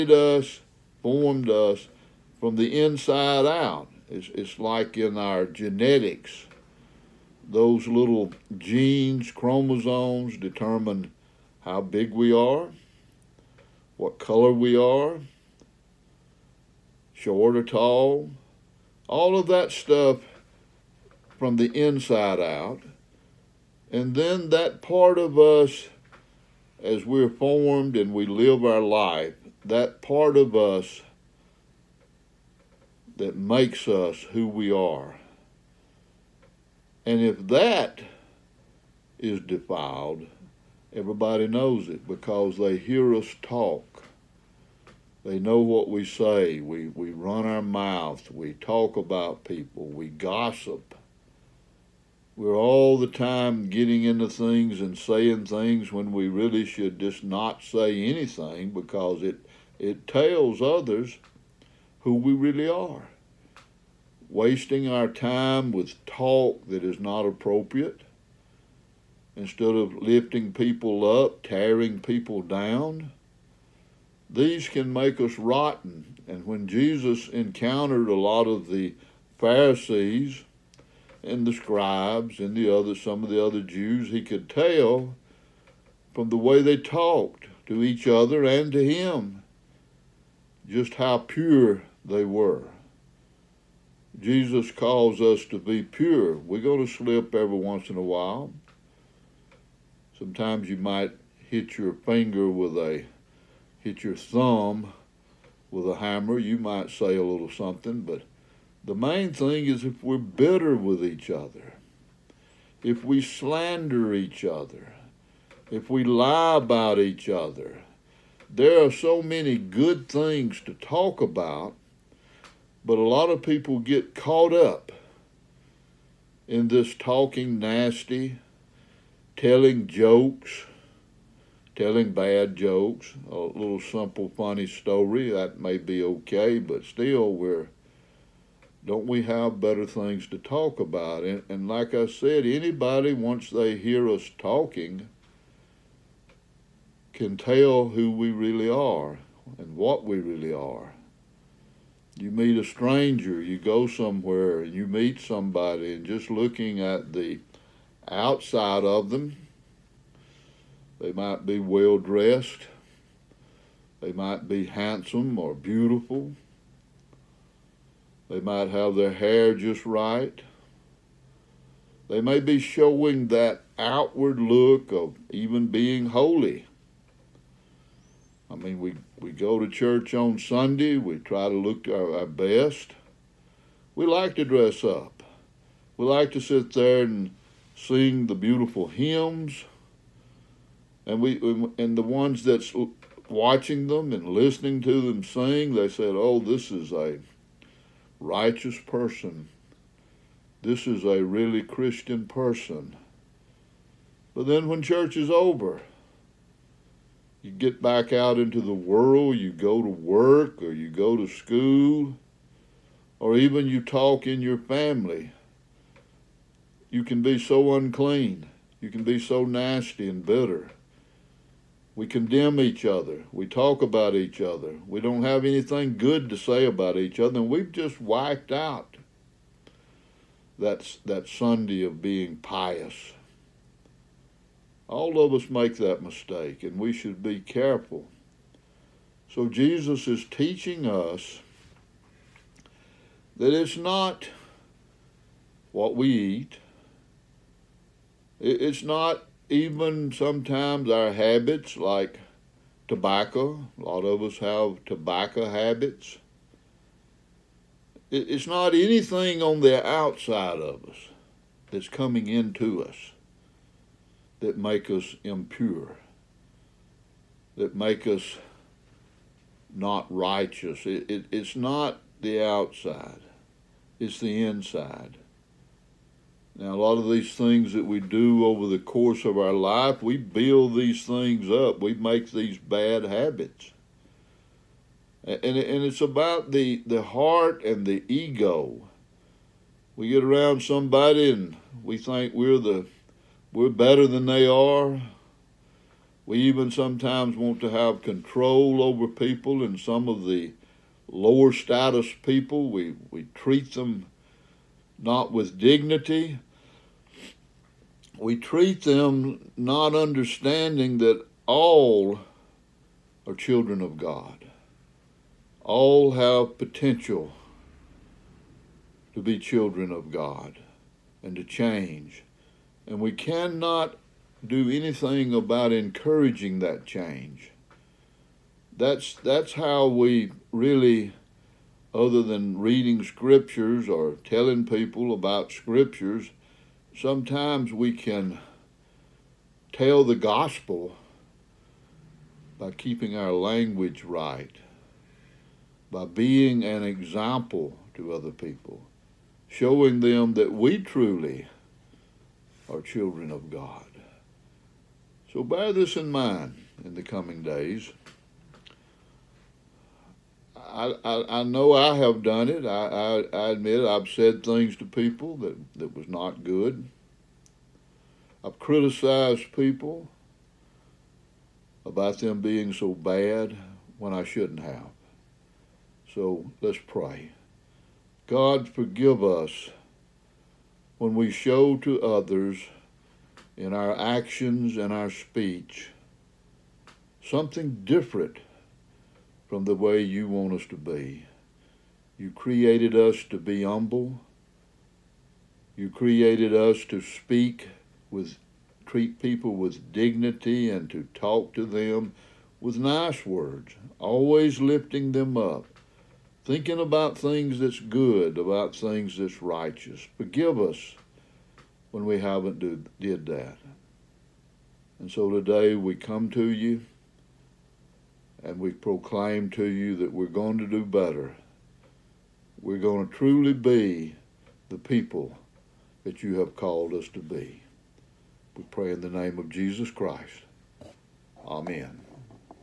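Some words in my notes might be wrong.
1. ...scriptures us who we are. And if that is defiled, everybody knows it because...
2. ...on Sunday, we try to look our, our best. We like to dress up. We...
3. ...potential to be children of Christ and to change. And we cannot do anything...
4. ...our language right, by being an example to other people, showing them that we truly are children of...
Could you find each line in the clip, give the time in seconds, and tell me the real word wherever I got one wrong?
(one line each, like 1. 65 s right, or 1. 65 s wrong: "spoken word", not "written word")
1. 33 s wrong: "makes", not "scriptures"
2. 180 s right
3. 316 s wrong: "God", not "Christ"
4. 343 s right.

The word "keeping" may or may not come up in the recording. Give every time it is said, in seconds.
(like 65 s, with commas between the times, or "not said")
342 s.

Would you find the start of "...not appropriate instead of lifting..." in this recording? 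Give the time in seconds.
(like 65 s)
66 s.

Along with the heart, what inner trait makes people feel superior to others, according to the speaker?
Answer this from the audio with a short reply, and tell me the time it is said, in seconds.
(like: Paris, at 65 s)
ego, at 288 s.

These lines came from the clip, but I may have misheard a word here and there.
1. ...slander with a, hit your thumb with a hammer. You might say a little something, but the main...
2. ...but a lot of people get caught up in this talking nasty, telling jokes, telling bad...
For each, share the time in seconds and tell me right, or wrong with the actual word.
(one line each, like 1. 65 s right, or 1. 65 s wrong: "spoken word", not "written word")
1. 101 s wrong: "finger", not "slander"
2. 122 s right.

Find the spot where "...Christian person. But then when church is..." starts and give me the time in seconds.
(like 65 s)
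201 s.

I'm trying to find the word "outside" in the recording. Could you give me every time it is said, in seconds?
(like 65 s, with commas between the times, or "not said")
158 s, 259 s, 272 s.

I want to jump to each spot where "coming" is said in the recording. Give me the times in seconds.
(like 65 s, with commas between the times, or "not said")
261 s, 357 s.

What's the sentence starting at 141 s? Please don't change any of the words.
And, and like I said, anybody, once they hear us talking, can tell who we really are and what we really are.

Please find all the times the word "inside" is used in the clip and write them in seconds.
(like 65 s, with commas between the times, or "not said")
2 s, 21 s, 274 s.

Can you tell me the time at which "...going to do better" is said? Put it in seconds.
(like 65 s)
420 s.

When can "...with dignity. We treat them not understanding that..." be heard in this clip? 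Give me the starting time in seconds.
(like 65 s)
305 s.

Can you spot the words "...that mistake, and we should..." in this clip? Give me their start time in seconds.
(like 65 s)
235 s.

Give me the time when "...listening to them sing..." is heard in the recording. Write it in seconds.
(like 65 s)
194 s.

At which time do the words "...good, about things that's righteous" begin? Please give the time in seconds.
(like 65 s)
407 s.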